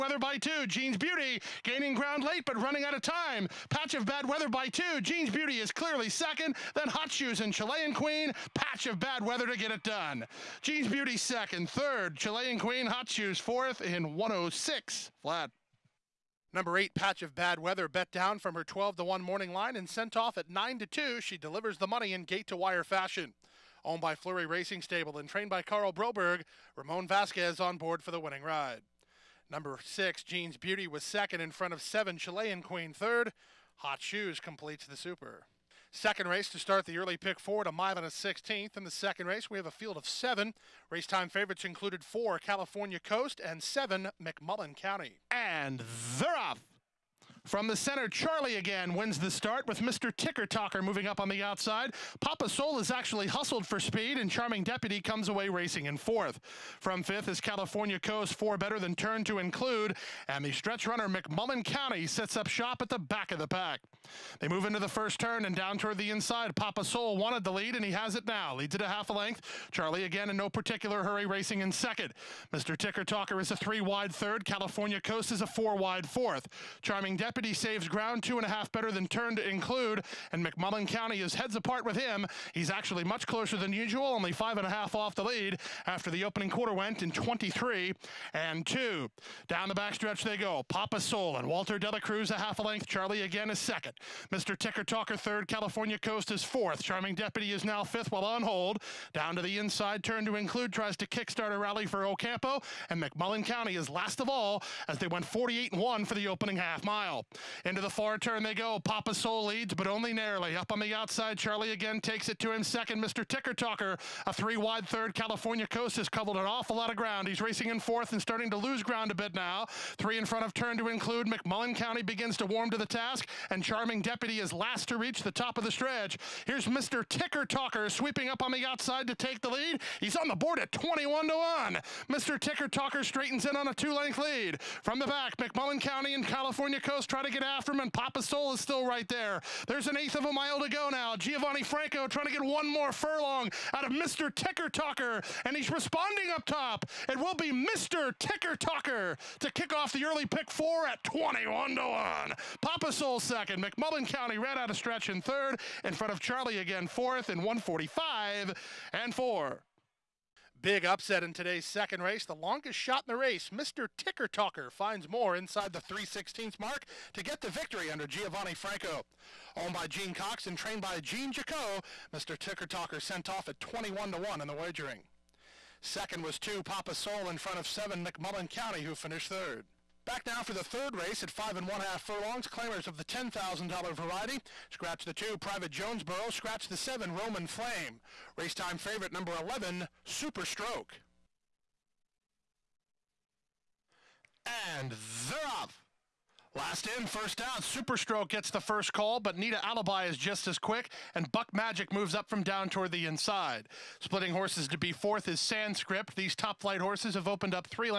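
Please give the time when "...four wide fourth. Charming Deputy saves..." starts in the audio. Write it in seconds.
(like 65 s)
75 s.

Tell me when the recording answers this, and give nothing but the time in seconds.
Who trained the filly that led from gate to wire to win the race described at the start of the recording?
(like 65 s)
25 s.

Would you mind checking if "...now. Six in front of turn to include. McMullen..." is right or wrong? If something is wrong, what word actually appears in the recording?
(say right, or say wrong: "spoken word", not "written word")
wrong: "Three", not "Six".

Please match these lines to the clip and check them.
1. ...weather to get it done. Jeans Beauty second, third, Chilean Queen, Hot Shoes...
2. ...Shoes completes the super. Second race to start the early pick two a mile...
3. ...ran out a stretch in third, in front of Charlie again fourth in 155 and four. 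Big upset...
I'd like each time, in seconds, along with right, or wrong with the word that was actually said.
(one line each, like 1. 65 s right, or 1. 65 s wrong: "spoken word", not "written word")
1. 9 s right
2. 33 s wrong: "four", not "two"
3. 154 s wrong: "145", not "155".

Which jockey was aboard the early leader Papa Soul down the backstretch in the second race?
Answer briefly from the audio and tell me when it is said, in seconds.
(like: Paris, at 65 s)
Walter Delacruz, at 91 s.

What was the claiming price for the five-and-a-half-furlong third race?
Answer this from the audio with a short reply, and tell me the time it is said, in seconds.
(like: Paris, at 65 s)
$10,000, at 183 s.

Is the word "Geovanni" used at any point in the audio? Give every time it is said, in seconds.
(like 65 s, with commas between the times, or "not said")
141 s, 168 s.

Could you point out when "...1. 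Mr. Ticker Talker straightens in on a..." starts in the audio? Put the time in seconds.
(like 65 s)
131 s.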